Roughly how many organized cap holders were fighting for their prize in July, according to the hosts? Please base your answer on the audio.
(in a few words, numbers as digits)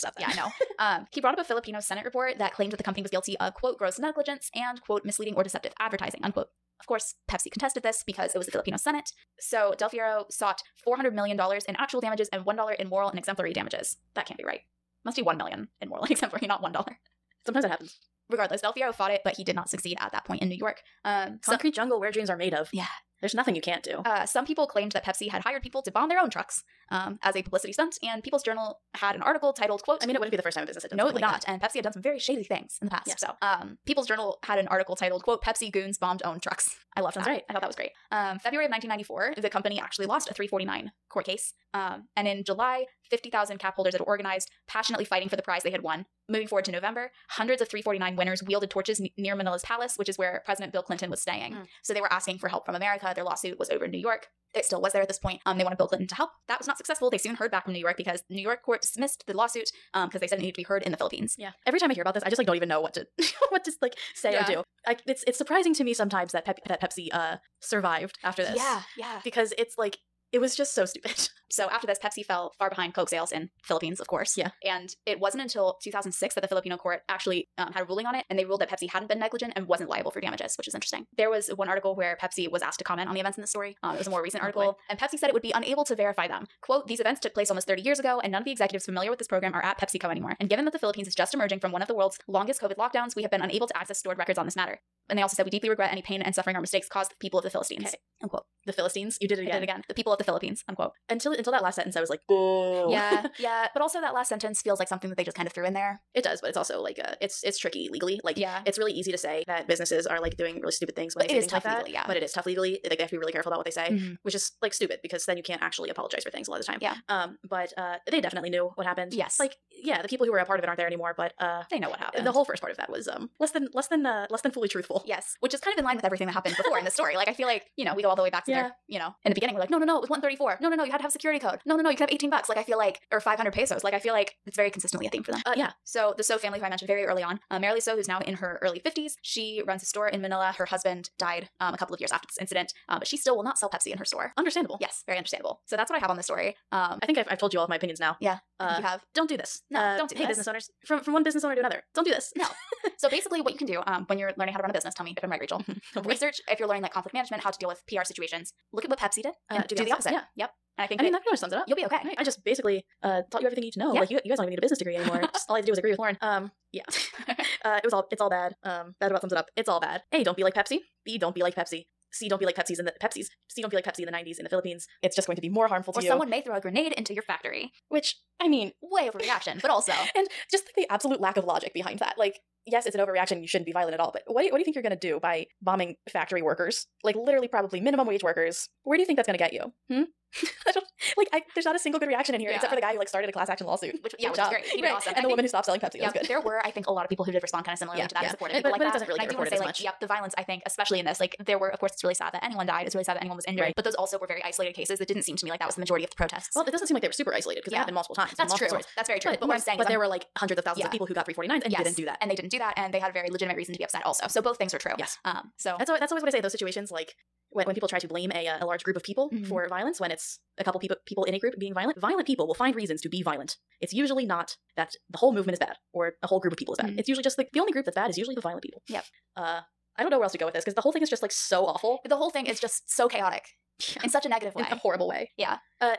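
50,000.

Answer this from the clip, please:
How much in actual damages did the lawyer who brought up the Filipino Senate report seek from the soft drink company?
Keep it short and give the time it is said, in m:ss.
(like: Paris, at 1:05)
$400 million, at 0:10.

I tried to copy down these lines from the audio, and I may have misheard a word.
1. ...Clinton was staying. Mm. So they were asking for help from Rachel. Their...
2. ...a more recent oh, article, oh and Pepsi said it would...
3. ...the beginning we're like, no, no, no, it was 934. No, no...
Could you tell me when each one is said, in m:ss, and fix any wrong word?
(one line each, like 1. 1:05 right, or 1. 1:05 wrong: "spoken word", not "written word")
1. 0:50 wrong: "America", not "Rachel"
2. 1:24 right
3. 2:09 wrong: "134", not "934".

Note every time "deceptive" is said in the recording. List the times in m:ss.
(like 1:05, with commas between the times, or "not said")
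0:05.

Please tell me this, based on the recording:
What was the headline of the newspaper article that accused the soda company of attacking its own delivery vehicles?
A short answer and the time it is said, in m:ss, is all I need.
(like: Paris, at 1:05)
Pepsi goons bombed own trucks, at 0:35.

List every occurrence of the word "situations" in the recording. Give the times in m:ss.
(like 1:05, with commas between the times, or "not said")
2:38, 3:36.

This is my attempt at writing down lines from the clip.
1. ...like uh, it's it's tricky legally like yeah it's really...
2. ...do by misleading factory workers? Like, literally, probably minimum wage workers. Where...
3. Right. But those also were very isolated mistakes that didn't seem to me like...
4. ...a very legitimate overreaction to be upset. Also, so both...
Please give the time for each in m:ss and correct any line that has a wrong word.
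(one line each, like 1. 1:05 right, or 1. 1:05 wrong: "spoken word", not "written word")
1. 1:46 right
2. 3:04 wrong: "bombing", not "misleading"
3. 3:23 wrong: "cases", not "mistakes"
4. 3:33 wrong: "reason", not "overreaction".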